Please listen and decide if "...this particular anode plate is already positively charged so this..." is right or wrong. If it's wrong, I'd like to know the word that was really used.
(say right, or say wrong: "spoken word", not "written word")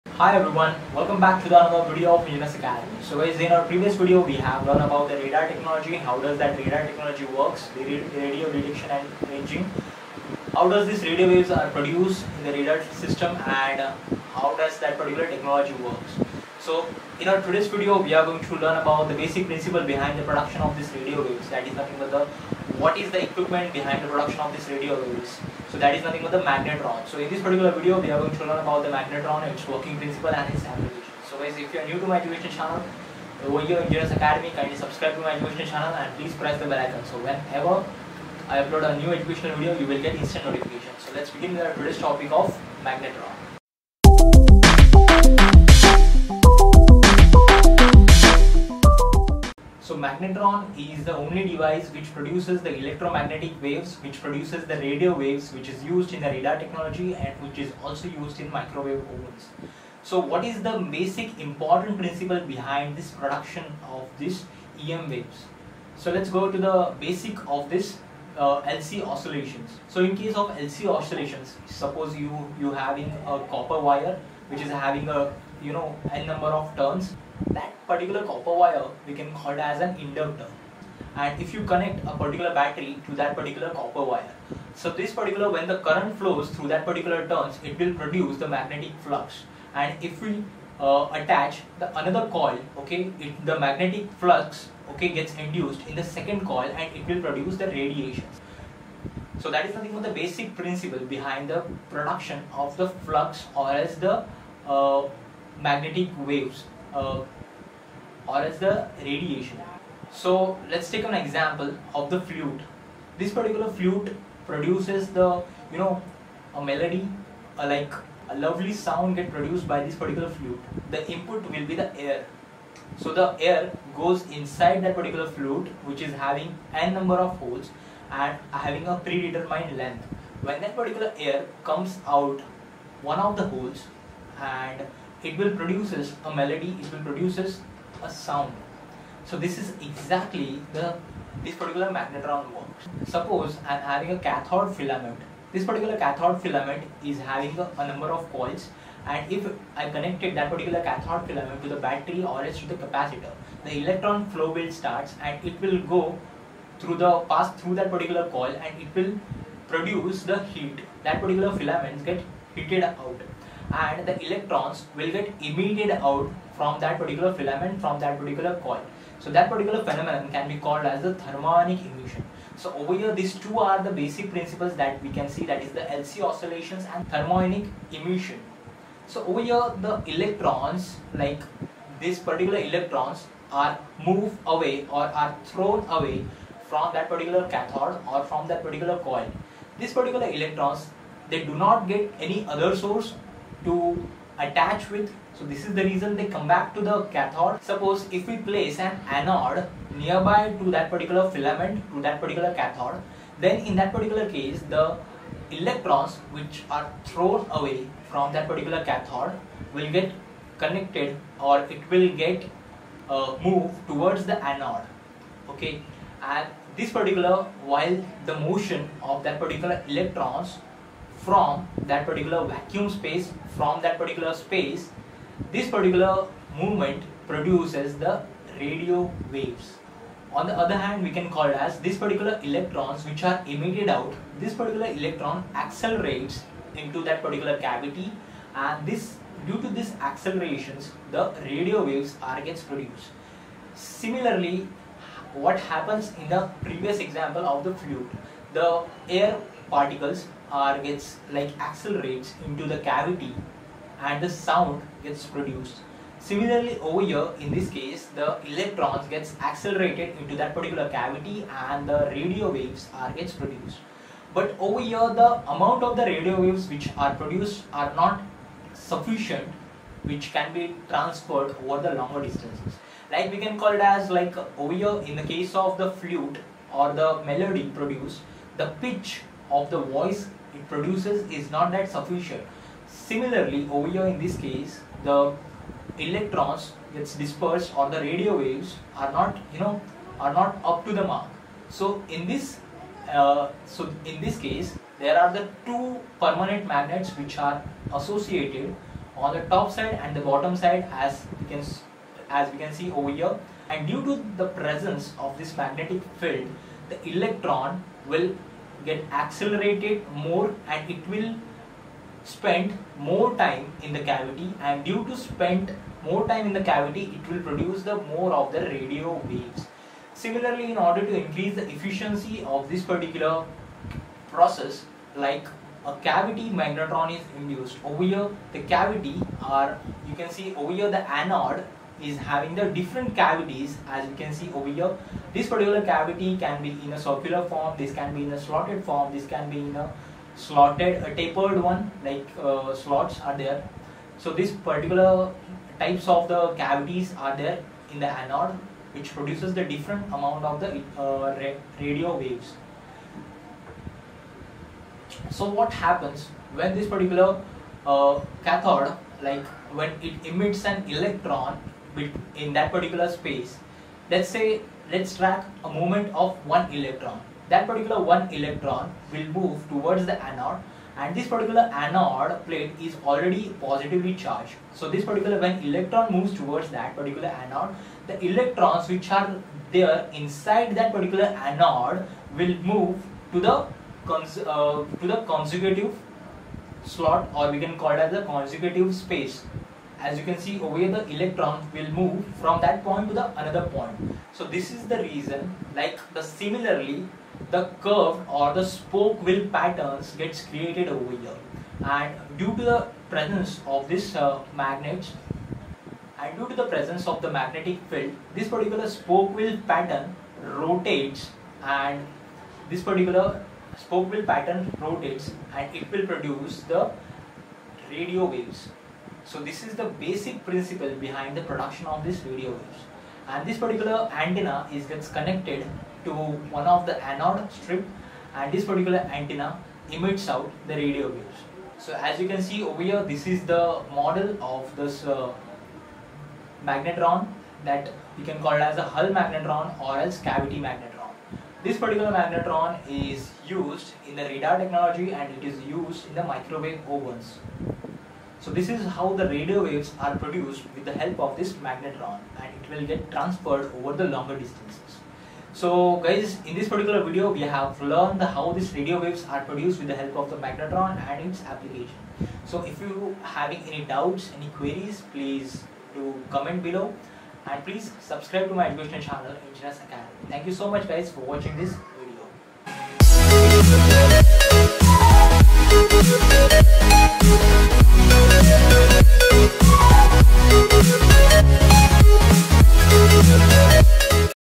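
right.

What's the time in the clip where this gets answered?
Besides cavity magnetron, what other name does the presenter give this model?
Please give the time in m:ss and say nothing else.
7:18.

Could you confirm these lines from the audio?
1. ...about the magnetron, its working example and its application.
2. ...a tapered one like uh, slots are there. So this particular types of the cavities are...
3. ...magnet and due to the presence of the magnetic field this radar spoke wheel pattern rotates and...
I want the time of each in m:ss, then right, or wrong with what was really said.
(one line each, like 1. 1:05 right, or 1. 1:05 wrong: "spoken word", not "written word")
1. 0:28 wrong: "principle", not "example"
2. 5:41 right
3. 6:44 wrong: "particular", not "radar".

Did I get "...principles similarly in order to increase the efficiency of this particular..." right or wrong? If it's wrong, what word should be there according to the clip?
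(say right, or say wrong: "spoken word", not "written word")
wrong: "waves", not "principles".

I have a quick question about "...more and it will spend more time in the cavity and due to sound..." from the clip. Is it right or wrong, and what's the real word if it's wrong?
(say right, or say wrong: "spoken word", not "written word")
wrong: "spend", not "sound".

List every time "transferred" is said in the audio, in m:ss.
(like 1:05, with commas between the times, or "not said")
4:30, 7:33.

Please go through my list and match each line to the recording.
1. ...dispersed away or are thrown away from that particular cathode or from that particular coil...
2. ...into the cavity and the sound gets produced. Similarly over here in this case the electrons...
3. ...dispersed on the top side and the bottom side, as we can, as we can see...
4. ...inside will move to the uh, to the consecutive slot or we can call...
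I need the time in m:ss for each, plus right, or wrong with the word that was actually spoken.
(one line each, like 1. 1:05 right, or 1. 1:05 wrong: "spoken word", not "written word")
1. 3:04 wrong: "moved", not "dispersed"
2. 4:12 right
3. 4:57 wrong: "associated", not "dispersed"
4. 6:21 wrong: "anode", not "inside".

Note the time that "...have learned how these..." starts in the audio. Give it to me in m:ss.
7:37.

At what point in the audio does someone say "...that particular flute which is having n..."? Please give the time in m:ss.
2:04.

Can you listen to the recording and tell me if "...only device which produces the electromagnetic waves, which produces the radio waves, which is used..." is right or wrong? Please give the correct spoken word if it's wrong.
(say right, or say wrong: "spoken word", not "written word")
right.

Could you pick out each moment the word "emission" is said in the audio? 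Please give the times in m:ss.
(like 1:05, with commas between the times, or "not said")
2:51, 2:57.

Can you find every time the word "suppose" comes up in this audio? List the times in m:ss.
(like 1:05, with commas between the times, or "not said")
1:11, 2:23, 3:17.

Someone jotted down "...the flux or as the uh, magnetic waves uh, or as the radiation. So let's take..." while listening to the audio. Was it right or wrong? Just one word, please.
right.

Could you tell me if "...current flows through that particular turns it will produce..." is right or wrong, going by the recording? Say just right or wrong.
right.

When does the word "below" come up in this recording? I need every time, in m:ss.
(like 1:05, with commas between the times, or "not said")
7:46.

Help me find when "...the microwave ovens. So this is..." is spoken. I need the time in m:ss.
7:26.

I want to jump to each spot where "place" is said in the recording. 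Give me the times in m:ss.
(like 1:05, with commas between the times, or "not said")
3:18.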